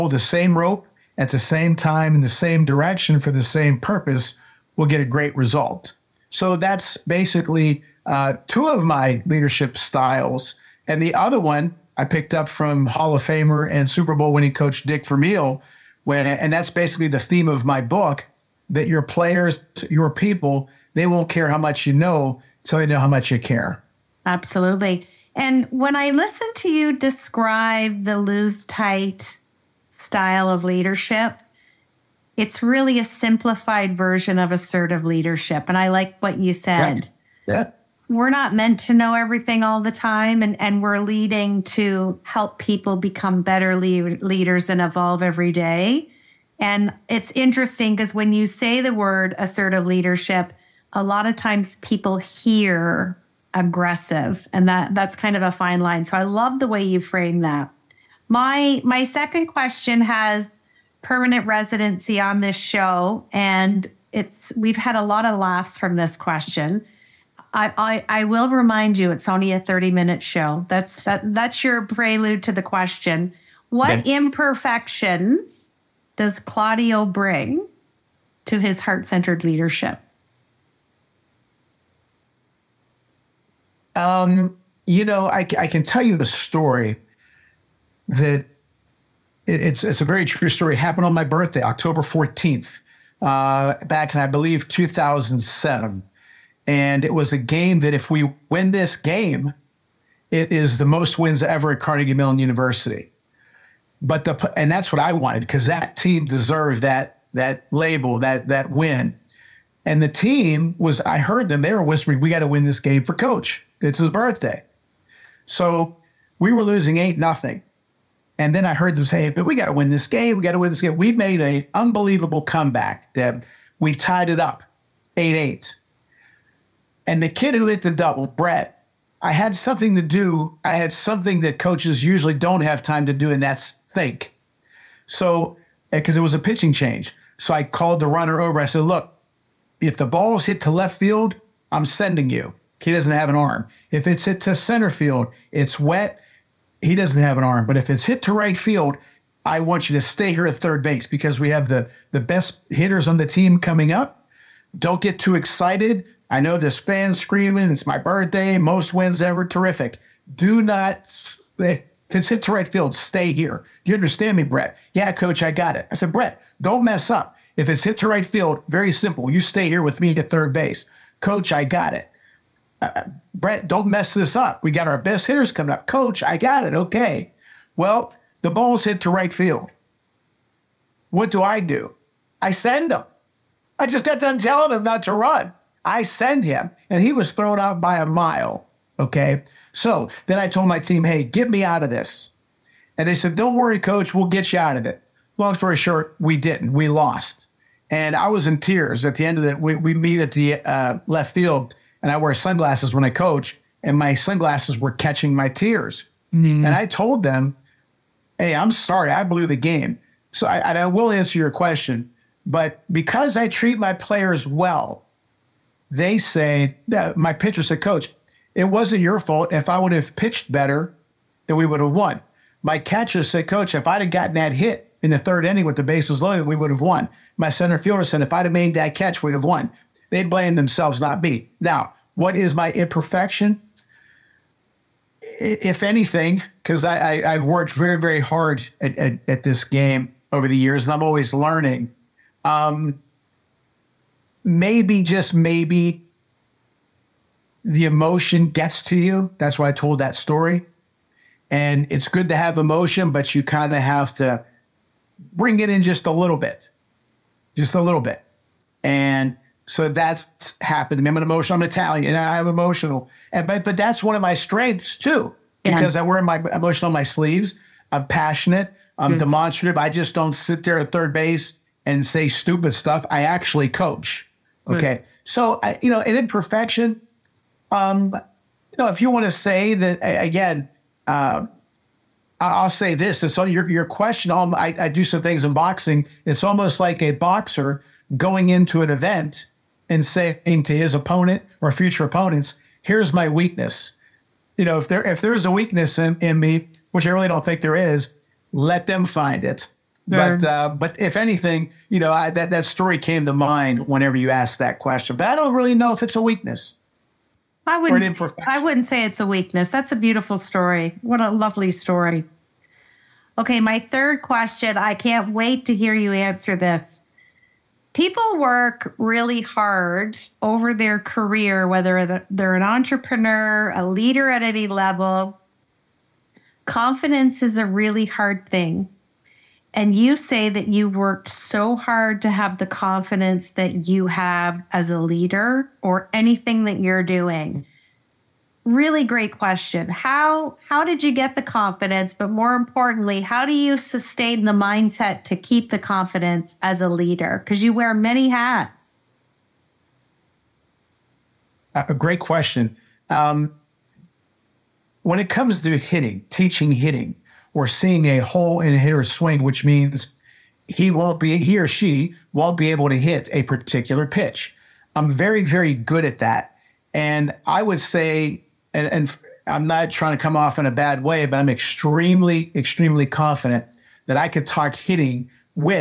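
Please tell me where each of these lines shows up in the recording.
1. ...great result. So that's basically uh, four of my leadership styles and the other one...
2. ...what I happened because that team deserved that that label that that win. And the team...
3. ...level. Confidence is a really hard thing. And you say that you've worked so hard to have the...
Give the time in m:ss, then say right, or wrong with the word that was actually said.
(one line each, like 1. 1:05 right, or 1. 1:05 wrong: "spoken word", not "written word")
1. 0:05 wrong: "two", not "four"
2. 1:44 wrong: "wanted", not "happened"
3. 5:24 right.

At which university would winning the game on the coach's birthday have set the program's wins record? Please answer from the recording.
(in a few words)
Carnegie Mellon University.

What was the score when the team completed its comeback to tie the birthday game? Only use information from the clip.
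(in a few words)
8-8.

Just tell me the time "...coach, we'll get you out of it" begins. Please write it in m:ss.
3:13.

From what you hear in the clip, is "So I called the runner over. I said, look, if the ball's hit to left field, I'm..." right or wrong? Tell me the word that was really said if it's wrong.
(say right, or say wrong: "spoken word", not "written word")
right.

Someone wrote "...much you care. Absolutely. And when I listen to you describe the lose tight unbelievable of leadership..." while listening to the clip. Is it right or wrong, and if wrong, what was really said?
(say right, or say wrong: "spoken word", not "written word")
wrong: "style", not "unbelievable".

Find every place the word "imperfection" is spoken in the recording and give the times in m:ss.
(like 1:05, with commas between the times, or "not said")
1:14, 3:52, 4:36.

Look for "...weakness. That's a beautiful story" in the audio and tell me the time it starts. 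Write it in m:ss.
5:09.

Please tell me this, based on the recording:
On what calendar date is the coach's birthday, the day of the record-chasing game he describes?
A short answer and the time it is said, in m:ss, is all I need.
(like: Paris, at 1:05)
October 14th, at 1:31.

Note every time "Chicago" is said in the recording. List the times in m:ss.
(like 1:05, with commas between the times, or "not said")
not said.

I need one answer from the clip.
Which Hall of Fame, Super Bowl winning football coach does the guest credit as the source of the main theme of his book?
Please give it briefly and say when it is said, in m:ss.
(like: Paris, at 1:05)
Dick Vermeil, at 0:14.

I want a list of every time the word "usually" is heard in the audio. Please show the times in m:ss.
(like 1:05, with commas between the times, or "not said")
2:12.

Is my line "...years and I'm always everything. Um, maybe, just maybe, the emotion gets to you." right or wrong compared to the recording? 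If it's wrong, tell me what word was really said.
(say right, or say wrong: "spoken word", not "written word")
wrong: "learning", not "everything".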